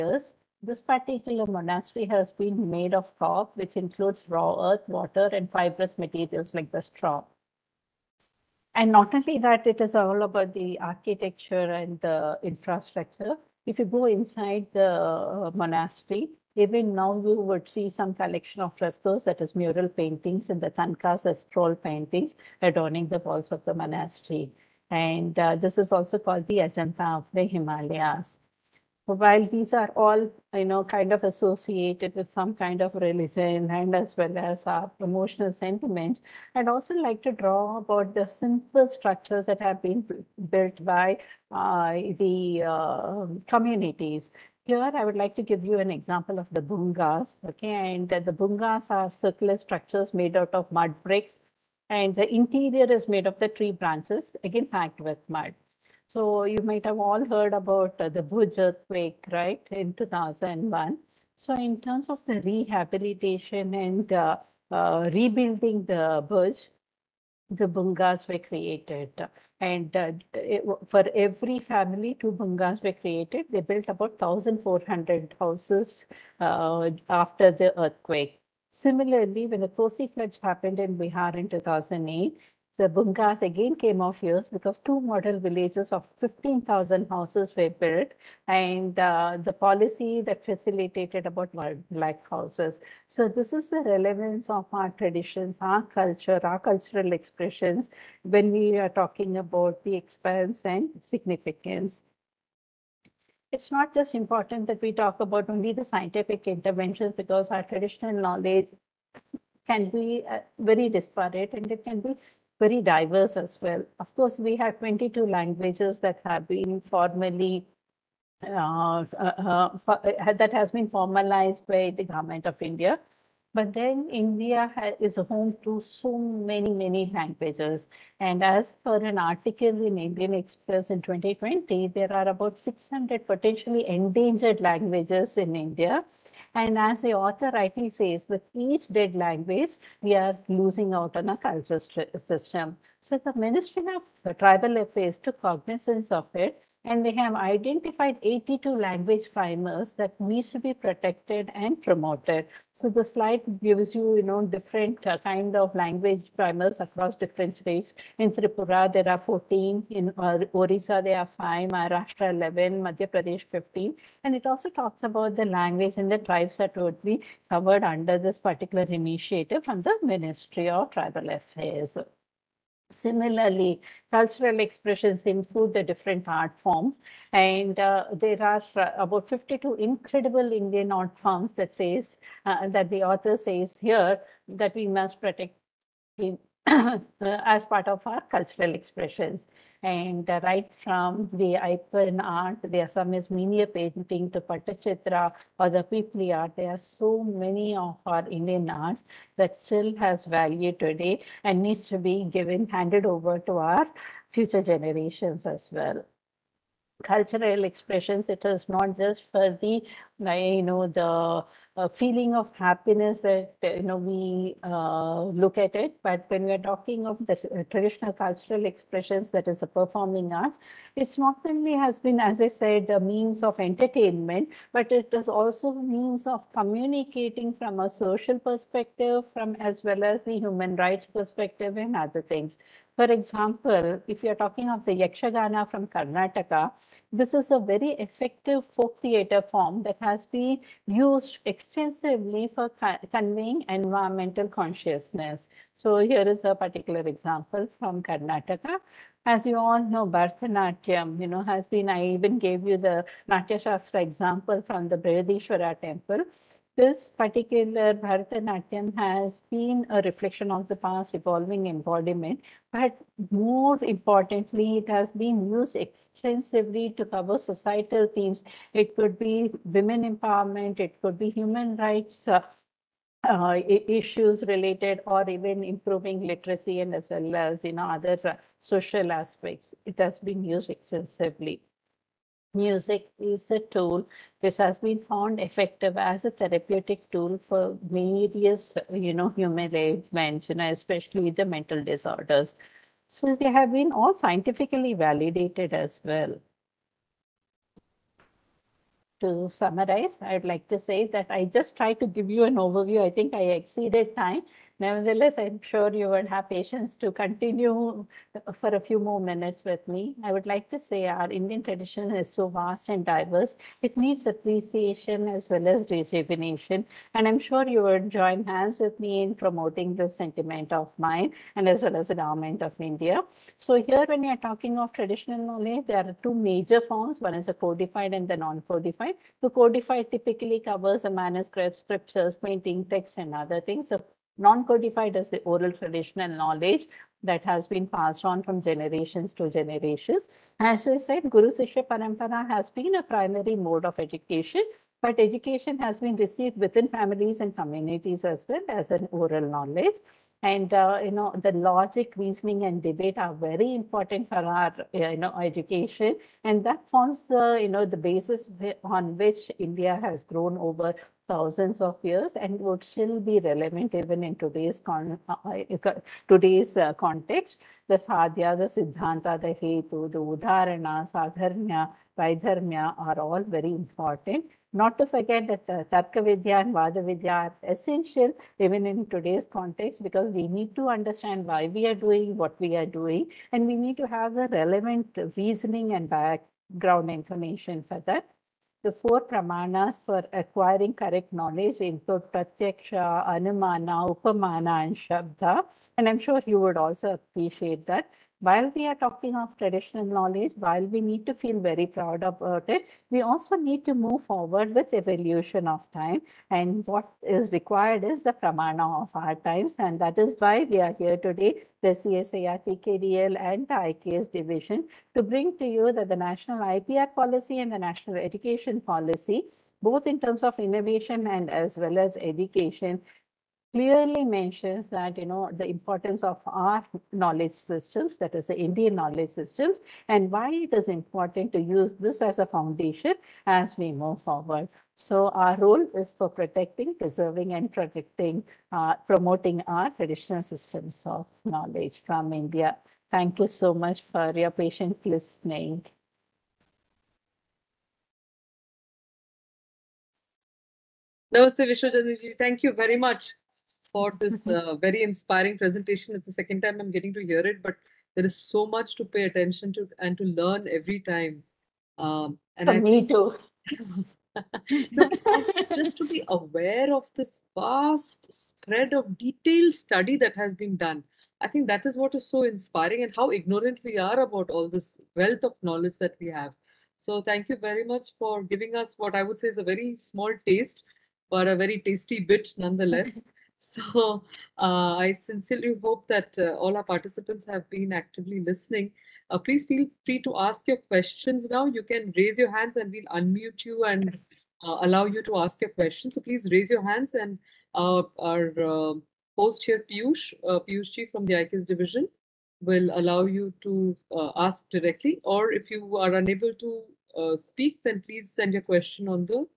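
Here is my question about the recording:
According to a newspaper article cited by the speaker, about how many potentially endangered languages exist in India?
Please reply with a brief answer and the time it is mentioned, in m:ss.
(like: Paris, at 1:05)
600, at 2:12.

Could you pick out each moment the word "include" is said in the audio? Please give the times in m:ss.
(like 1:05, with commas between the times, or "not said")
0:03, 2:55, 6:31.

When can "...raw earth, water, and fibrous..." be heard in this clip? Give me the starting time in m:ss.
0:04.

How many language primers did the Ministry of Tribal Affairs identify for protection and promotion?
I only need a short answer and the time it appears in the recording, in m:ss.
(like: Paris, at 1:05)
82, at 2:28.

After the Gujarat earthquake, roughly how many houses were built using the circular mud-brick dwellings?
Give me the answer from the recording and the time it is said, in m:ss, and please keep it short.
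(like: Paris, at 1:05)
1400, at 1:14.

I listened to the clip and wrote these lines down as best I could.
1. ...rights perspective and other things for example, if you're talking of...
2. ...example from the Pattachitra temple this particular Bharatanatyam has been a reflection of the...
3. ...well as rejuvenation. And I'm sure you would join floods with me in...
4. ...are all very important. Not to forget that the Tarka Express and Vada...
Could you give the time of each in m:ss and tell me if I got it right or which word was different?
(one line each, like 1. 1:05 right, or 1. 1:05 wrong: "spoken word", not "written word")
1. 3:50 right
2. 4:13 wrong: "Brihadeeswara", not "Pattachitra"
3. 5:15 wrong: "hands", not "floods"
4. 6:12 wrong: "Vidya", not "Express".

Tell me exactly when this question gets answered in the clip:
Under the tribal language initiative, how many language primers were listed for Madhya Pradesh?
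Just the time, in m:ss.
2:43.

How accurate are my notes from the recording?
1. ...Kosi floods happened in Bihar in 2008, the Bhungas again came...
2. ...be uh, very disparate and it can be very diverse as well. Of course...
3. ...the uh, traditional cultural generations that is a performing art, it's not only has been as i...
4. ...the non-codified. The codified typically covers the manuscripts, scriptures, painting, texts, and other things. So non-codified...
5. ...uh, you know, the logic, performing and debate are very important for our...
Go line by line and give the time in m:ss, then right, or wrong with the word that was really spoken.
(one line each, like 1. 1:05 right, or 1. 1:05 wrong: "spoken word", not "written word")
1. 1:19 right
2. 1:49 right
3. 3:37 wrong: "expressions", not "generations"
4. 5:28 right
5. 5:50 wrong: "reasoning", not "performing".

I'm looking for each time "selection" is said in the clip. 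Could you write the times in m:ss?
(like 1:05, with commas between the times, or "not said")
not said.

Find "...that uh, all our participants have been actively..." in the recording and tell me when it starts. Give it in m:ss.
8:06.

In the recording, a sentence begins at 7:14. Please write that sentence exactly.
So our role is for protecting, preserving, and protecting, uh, promoting our traditional systems of knowledge from India.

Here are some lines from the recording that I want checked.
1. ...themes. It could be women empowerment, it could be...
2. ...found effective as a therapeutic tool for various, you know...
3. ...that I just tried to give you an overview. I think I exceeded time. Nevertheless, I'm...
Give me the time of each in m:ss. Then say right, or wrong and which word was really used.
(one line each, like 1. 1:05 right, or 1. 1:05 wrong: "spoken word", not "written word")
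1. 4:28 right
2. 4:45 right
3. 5:01 right.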